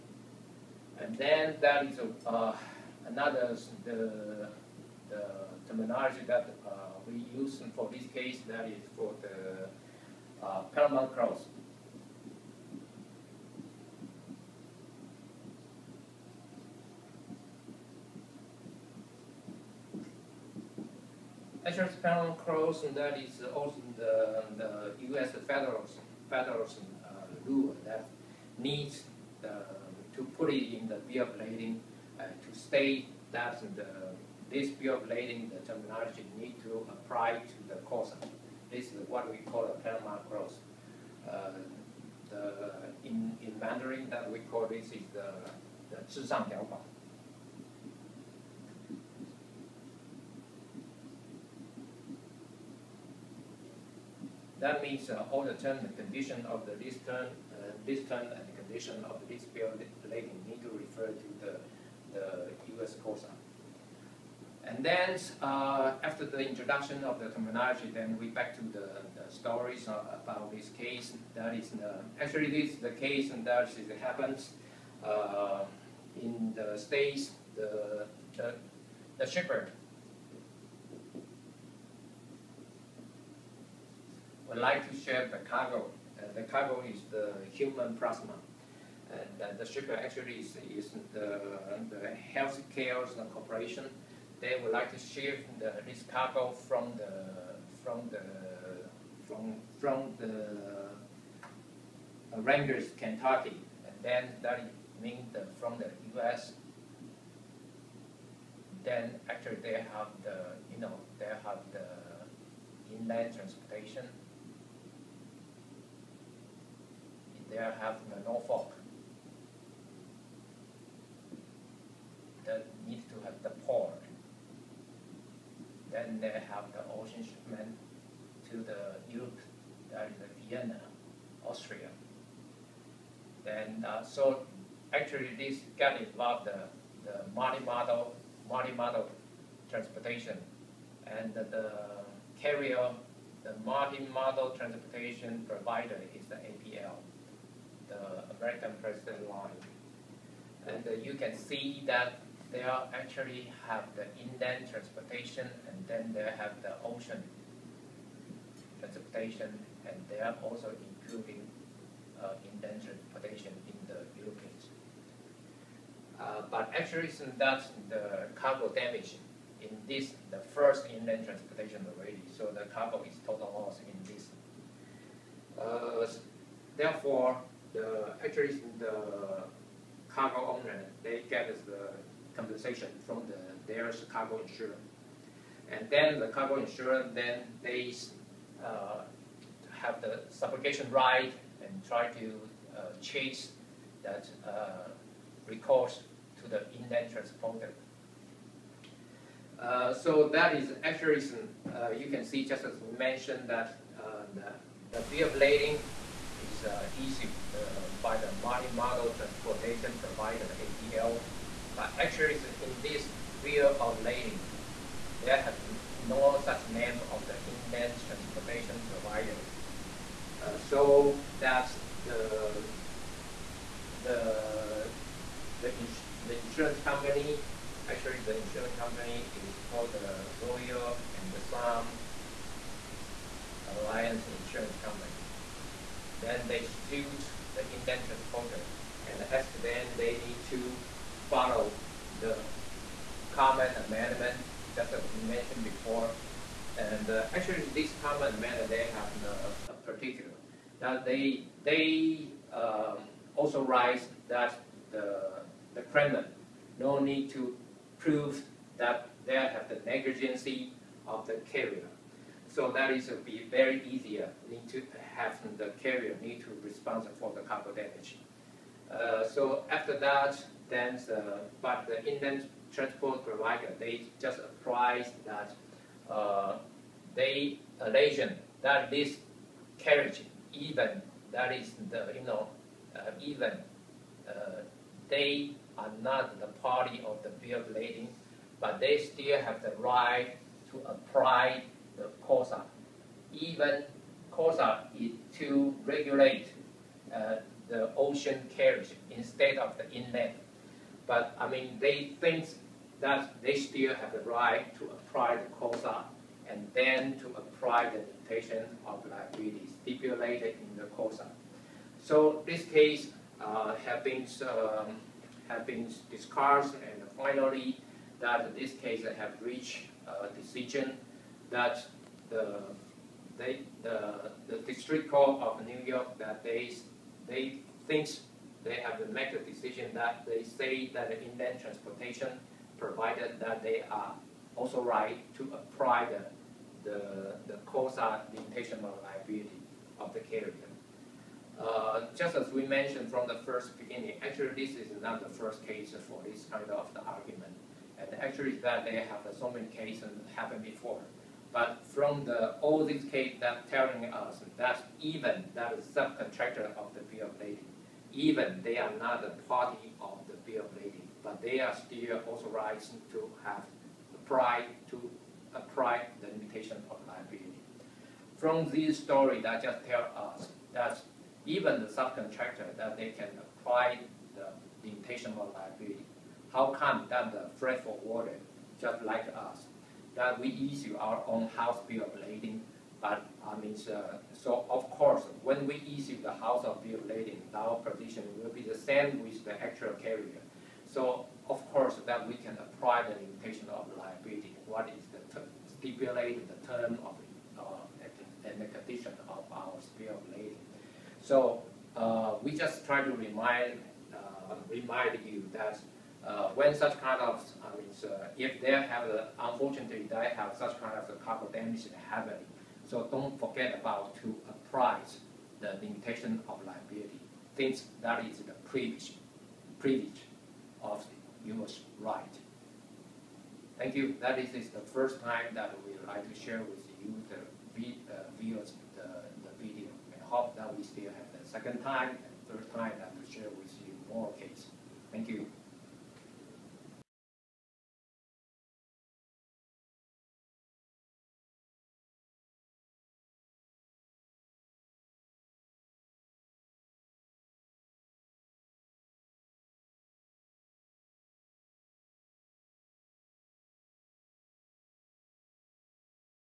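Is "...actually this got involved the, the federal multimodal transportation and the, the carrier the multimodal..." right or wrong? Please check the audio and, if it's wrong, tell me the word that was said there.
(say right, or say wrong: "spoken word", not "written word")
wrong: "multimodal", not "federal".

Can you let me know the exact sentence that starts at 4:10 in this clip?
Now they they um, also write that the the claimant no need to prove that they have the negligency of the carrier.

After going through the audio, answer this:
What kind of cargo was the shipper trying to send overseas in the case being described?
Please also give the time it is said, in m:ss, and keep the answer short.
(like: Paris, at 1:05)
Human plasma, at 1:26.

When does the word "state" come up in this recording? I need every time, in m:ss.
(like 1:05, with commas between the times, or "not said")
0:32, 1:16.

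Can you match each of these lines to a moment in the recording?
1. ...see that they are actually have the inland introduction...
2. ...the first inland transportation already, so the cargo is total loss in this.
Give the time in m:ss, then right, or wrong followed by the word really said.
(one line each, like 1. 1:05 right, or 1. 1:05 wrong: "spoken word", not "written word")
1. 2:31 wrong: "transportation", not "introduction"
2. 2:50 right.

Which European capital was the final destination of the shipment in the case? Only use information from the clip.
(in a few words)
Vienna, Austria.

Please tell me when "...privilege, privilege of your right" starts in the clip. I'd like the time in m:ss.
6:58.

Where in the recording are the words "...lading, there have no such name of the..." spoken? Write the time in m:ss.
3:34.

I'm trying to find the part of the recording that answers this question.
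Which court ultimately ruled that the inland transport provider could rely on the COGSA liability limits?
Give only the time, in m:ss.
5:24.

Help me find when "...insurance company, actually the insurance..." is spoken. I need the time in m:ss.
3:46.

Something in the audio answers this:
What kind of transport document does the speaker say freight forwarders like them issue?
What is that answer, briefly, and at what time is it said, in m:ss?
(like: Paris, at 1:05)
House Bill of Lading, at 6:21.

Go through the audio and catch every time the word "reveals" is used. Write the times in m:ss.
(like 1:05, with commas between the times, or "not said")
not said.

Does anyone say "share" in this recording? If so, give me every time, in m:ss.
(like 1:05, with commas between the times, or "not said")
1:24, 7:06, 7:13.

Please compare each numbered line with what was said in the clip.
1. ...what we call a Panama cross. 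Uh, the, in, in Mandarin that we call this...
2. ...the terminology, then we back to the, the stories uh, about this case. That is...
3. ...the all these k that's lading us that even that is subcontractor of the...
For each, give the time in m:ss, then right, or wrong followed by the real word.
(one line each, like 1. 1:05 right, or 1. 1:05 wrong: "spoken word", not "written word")
1. 0:39 right
2. 1:07 right
3. 5:52 wrong: "telling", not "lading".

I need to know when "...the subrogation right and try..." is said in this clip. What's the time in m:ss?
3:10.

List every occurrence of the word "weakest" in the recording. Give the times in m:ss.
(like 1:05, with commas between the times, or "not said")
not said.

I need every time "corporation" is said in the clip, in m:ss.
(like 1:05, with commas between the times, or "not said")
1:33.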